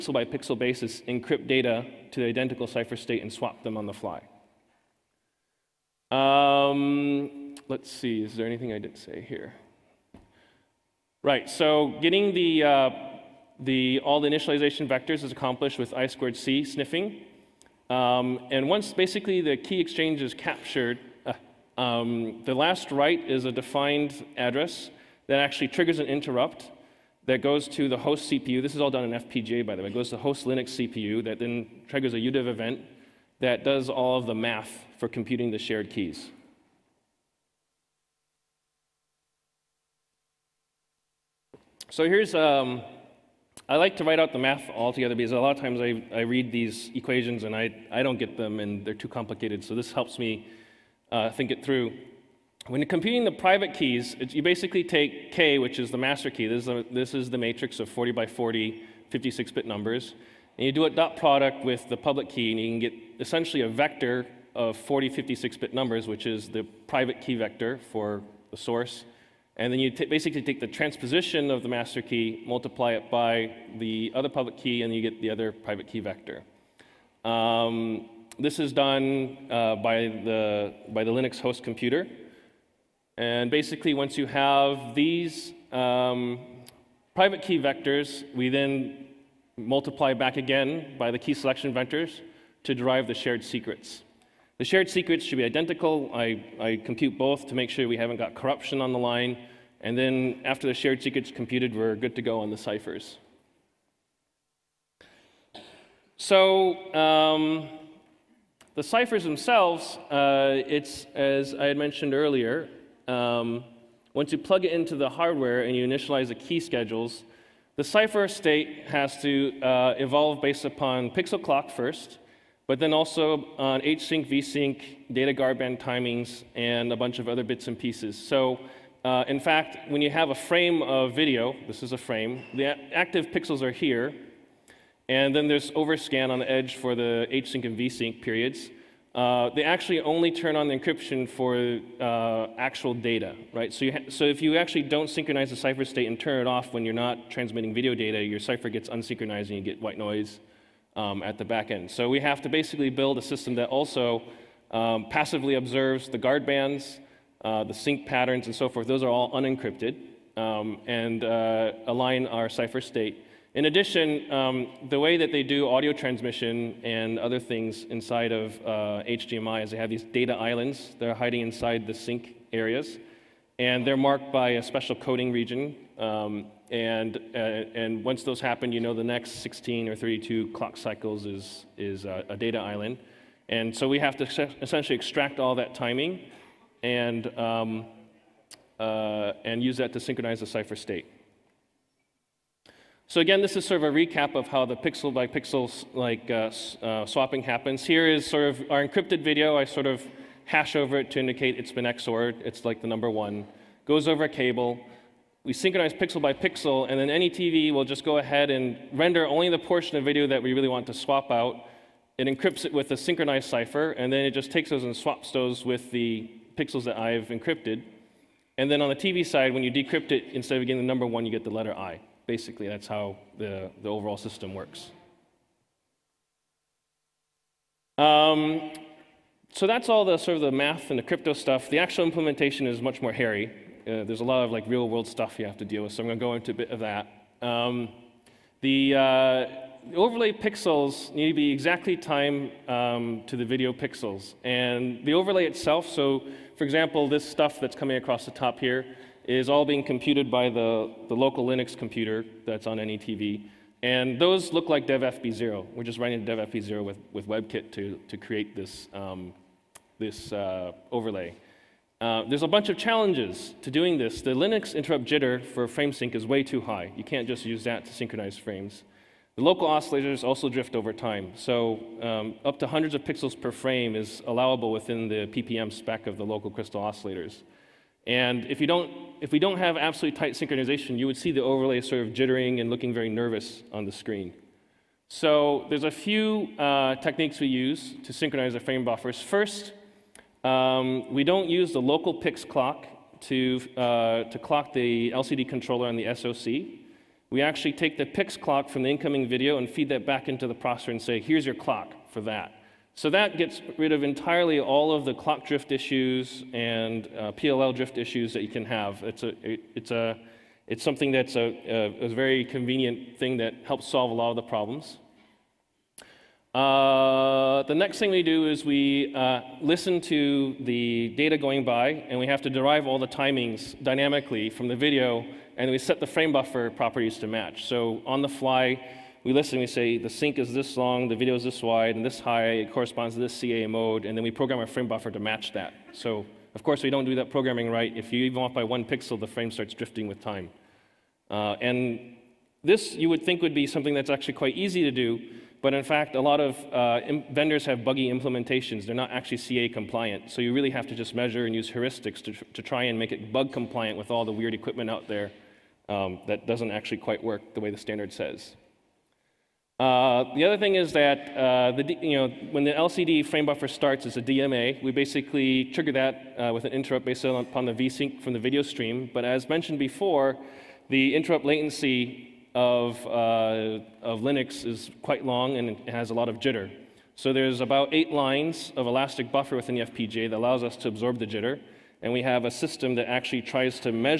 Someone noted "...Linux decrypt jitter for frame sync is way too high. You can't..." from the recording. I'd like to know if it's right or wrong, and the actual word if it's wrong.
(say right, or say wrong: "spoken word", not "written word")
wrong: "interrupt", not "decrypt".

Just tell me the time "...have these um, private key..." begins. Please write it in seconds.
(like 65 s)
84 s.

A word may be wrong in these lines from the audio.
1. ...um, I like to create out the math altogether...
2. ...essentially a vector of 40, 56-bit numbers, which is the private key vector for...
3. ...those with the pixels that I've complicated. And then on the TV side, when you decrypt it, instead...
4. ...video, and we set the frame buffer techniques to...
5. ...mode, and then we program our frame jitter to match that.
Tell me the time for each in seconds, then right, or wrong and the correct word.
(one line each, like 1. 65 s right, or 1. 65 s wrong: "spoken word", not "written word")
1. 42 s wrong: "write", not "create"
2. 63 s right
3. 215 s wrong: "encrypted", not "complicated"
4. 324 s wrong: "properties", not "techniques"
5. 333 s wrong: "buffer", not "jitter".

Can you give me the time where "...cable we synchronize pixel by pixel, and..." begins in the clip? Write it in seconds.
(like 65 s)
204 s.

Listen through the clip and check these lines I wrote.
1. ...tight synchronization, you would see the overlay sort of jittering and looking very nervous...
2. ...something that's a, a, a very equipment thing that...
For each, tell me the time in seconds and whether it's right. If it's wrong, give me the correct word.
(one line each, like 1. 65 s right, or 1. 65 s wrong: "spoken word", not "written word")
1. 280 s right
2. 310 s wrong: "convenient", not "equipment".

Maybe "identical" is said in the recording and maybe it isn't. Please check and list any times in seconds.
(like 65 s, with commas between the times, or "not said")
2 s, 95 s.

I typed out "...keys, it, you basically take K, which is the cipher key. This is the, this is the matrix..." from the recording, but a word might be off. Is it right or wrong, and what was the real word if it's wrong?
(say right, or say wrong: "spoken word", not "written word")
wrong: "master", not "cipher".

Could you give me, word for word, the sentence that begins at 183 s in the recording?
And so we have to essentially extract all that timing and, um, uh, and use that to synchronize the cipher state.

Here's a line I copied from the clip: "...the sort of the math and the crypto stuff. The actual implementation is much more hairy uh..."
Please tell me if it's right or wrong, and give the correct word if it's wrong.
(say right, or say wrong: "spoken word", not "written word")
right.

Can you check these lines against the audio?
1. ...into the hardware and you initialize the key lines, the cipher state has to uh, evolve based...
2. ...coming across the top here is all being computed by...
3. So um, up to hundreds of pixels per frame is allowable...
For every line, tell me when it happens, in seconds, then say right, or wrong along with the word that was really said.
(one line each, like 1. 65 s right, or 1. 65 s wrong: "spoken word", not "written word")
1. 114 s wrong: "schedules", not "lines"
2. 247 s right
3. 271 s right.